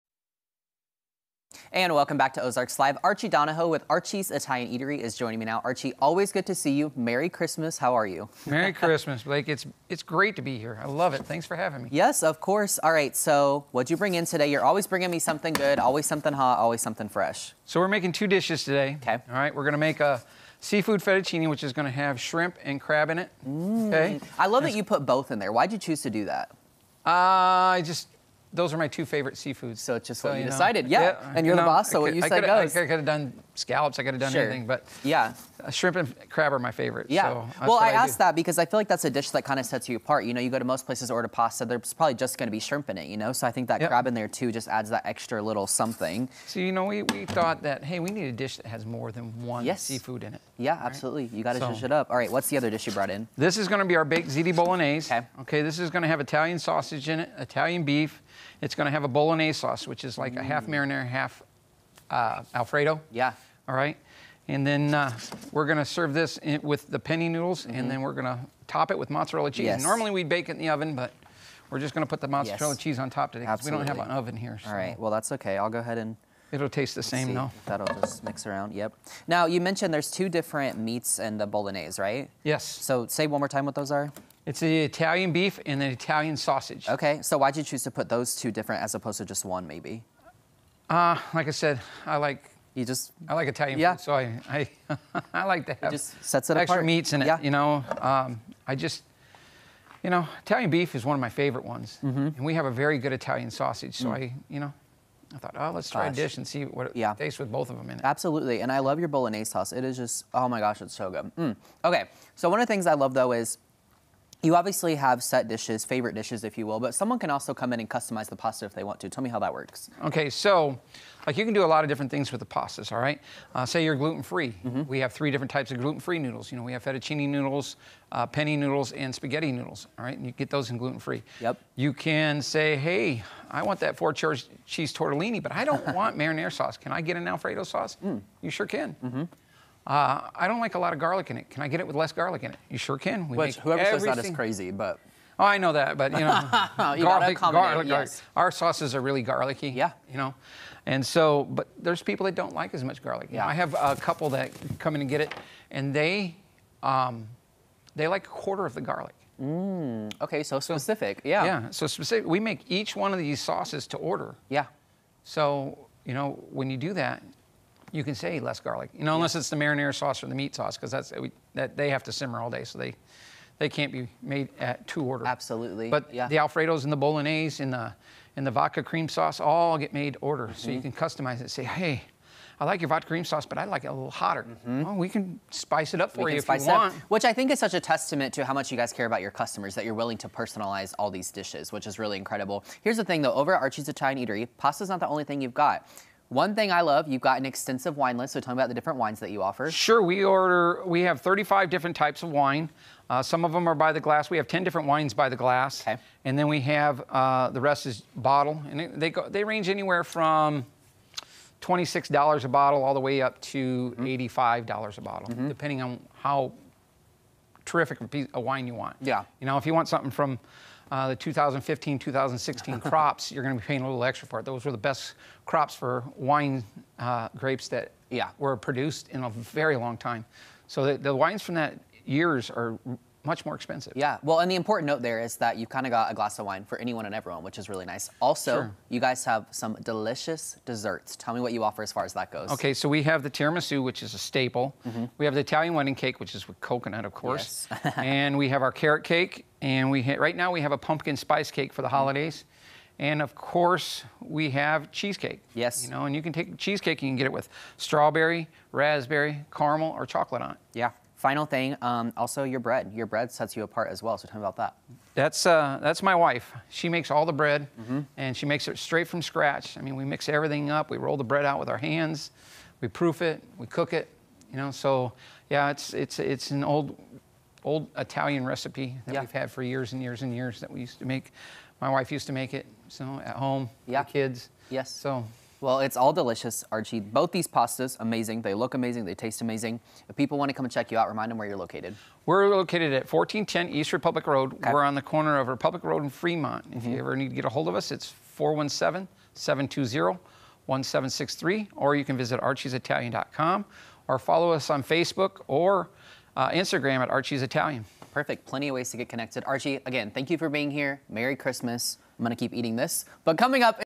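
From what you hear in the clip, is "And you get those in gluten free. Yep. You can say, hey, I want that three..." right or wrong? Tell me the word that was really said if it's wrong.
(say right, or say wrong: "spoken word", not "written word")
wrong: "four", not "three".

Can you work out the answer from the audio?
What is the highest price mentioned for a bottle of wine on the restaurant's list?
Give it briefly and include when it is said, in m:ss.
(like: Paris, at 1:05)
$85, at 3:34.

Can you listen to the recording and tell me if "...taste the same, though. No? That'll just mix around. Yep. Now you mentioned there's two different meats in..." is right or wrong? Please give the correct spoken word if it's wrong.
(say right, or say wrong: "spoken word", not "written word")
right.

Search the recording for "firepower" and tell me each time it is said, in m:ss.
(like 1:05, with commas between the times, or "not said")
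not said.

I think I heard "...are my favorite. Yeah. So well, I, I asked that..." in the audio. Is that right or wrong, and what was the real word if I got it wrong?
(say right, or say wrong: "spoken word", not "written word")
right.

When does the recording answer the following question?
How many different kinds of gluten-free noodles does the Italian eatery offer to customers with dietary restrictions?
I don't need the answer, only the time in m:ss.
2:05.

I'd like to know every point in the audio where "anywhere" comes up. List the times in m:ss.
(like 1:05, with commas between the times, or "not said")
3:29.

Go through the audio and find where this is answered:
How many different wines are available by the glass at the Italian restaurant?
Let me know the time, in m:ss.
3:24.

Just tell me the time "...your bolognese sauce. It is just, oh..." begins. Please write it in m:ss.
1:48.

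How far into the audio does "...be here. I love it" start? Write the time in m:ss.
0:10.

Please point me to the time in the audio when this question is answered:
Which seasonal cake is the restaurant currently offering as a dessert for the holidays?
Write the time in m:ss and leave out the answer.
4:10.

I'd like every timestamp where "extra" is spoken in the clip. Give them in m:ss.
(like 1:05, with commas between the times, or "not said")
0:45, 1:36, 3:44.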